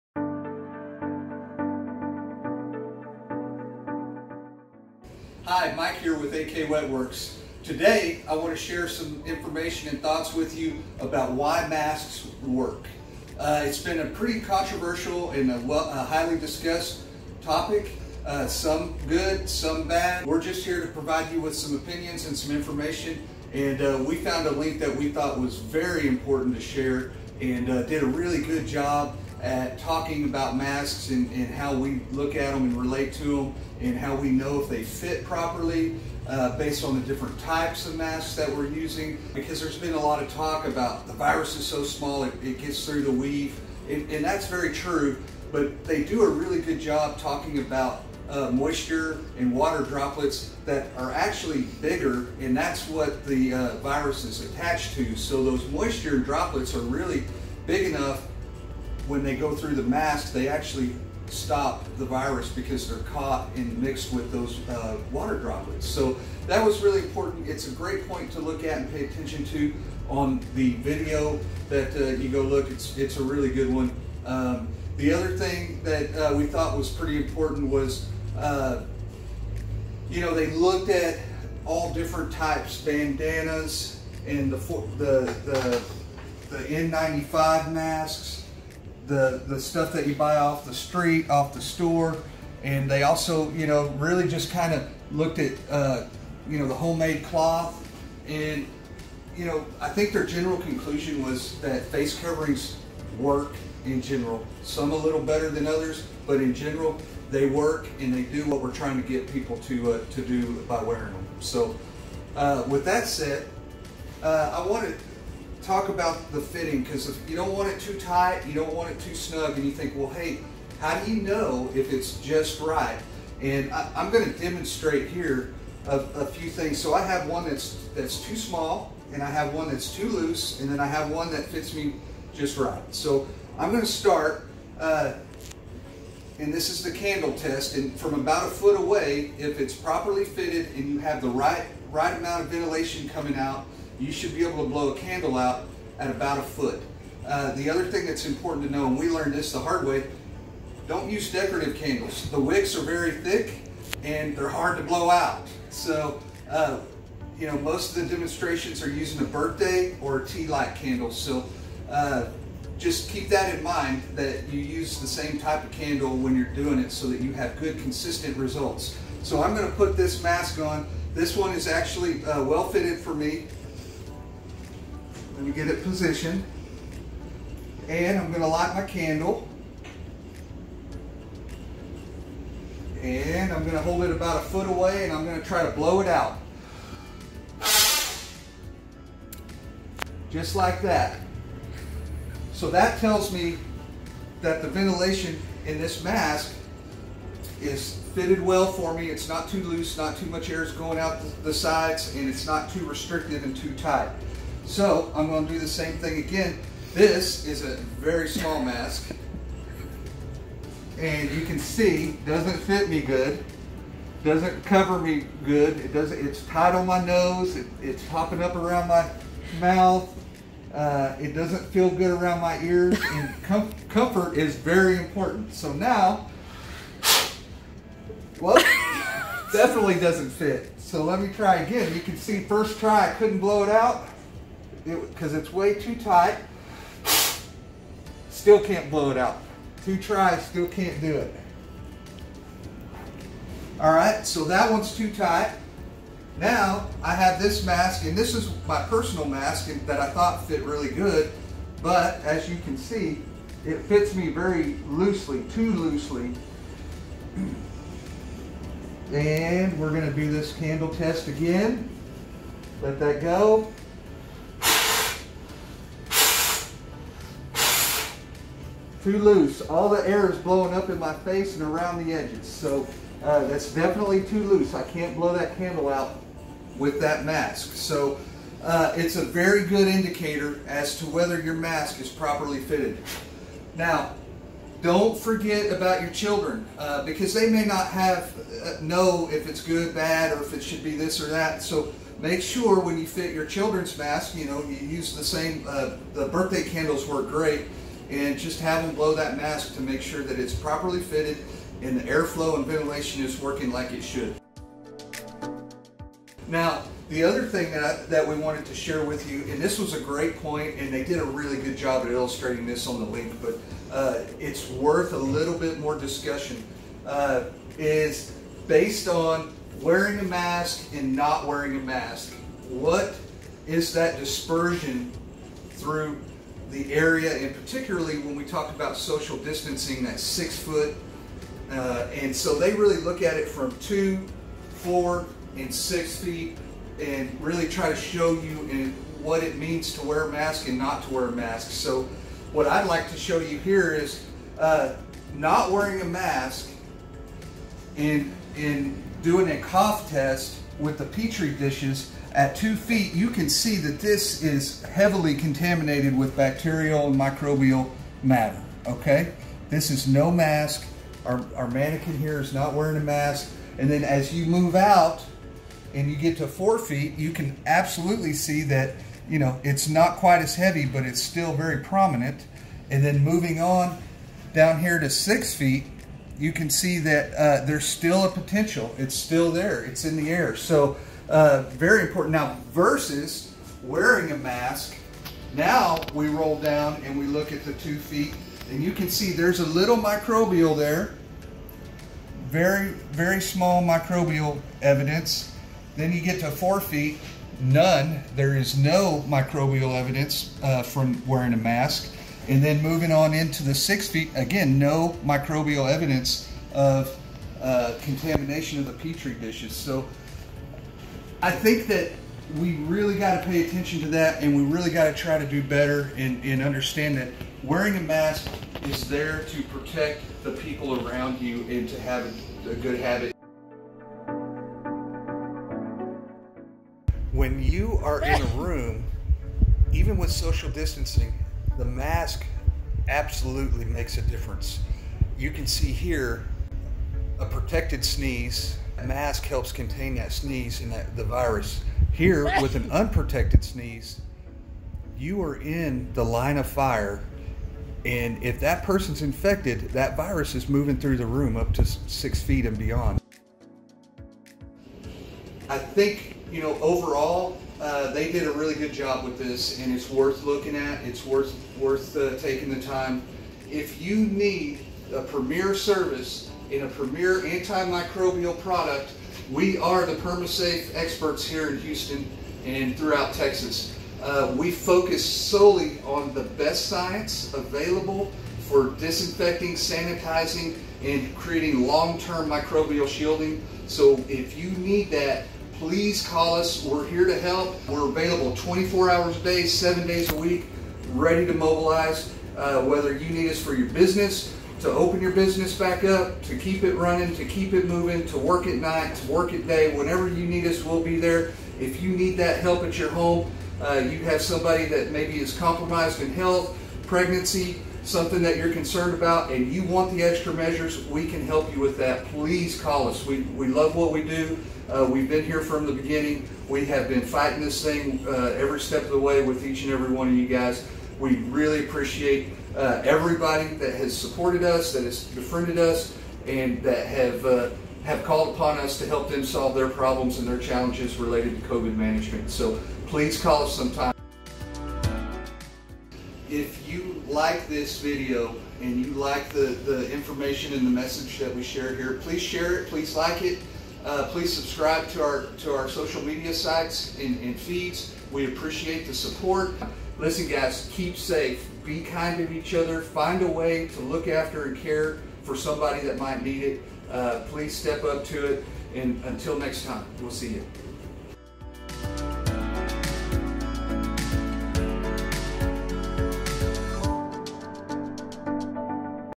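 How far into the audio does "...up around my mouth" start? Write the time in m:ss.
3:38.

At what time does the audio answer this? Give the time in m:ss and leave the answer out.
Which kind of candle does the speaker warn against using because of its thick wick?
2:31.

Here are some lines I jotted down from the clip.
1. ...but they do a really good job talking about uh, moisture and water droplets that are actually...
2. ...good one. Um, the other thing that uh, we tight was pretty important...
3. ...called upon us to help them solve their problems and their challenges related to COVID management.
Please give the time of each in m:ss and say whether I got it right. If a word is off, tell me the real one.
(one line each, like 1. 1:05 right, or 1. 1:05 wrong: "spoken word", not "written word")
1. 0:45 right
2. 1:13 wrong: "thought", not "tight"
3. 8:48 right.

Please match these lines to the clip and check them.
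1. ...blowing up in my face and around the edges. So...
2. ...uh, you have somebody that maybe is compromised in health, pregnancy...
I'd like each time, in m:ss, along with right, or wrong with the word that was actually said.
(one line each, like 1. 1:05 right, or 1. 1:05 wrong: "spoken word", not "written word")
1. 4:30 right
2. 8:23 right.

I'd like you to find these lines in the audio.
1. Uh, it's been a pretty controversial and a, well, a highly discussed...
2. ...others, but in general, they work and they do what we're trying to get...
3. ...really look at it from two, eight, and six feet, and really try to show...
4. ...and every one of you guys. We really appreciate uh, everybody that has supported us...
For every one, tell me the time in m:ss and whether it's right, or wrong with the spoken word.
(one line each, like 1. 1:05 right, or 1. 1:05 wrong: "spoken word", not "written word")
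1. 0:13 right
2. 1:45 right
3. 5:32 wrong: "four", not "eight"
4. 8:39 right.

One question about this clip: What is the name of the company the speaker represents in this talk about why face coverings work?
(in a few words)
AK Wet Works.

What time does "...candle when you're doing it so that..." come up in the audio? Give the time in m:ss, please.
2:45.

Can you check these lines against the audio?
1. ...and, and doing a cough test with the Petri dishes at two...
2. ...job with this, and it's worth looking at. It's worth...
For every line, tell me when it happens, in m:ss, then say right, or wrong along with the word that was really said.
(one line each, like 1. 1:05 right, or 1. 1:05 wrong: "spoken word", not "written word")
1. 5:47 right
2. 7:38 right.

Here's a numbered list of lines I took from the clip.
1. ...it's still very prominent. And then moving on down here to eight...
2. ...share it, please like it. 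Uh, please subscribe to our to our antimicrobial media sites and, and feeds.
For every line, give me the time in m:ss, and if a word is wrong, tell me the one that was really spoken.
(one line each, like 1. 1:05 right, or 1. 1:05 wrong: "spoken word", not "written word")
1. 6:11 wrong: "six", not "eight"
2. 9:02 wrong: "social", not "antimicrobial".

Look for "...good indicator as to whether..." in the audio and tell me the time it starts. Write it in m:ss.
4:39.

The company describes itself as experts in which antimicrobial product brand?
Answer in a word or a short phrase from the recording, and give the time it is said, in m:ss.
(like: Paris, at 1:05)
PermaSafe, at 7:50.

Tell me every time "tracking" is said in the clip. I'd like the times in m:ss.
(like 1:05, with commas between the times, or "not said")
not said.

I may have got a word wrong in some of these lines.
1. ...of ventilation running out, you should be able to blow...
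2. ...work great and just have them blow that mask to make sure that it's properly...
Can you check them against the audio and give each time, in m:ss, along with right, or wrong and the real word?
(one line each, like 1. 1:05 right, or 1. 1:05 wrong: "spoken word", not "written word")
1. 2:22 wrong: "coming", not "running"
2. 4:57 right.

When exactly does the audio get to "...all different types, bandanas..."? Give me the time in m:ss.
1:21.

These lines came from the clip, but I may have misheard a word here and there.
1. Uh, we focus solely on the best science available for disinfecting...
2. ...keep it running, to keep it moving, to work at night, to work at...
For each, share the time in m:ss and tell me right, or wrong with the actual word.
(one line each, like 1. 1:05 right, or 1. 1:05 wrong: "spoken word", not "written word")
1. 7:54 right
2. 8:16 right.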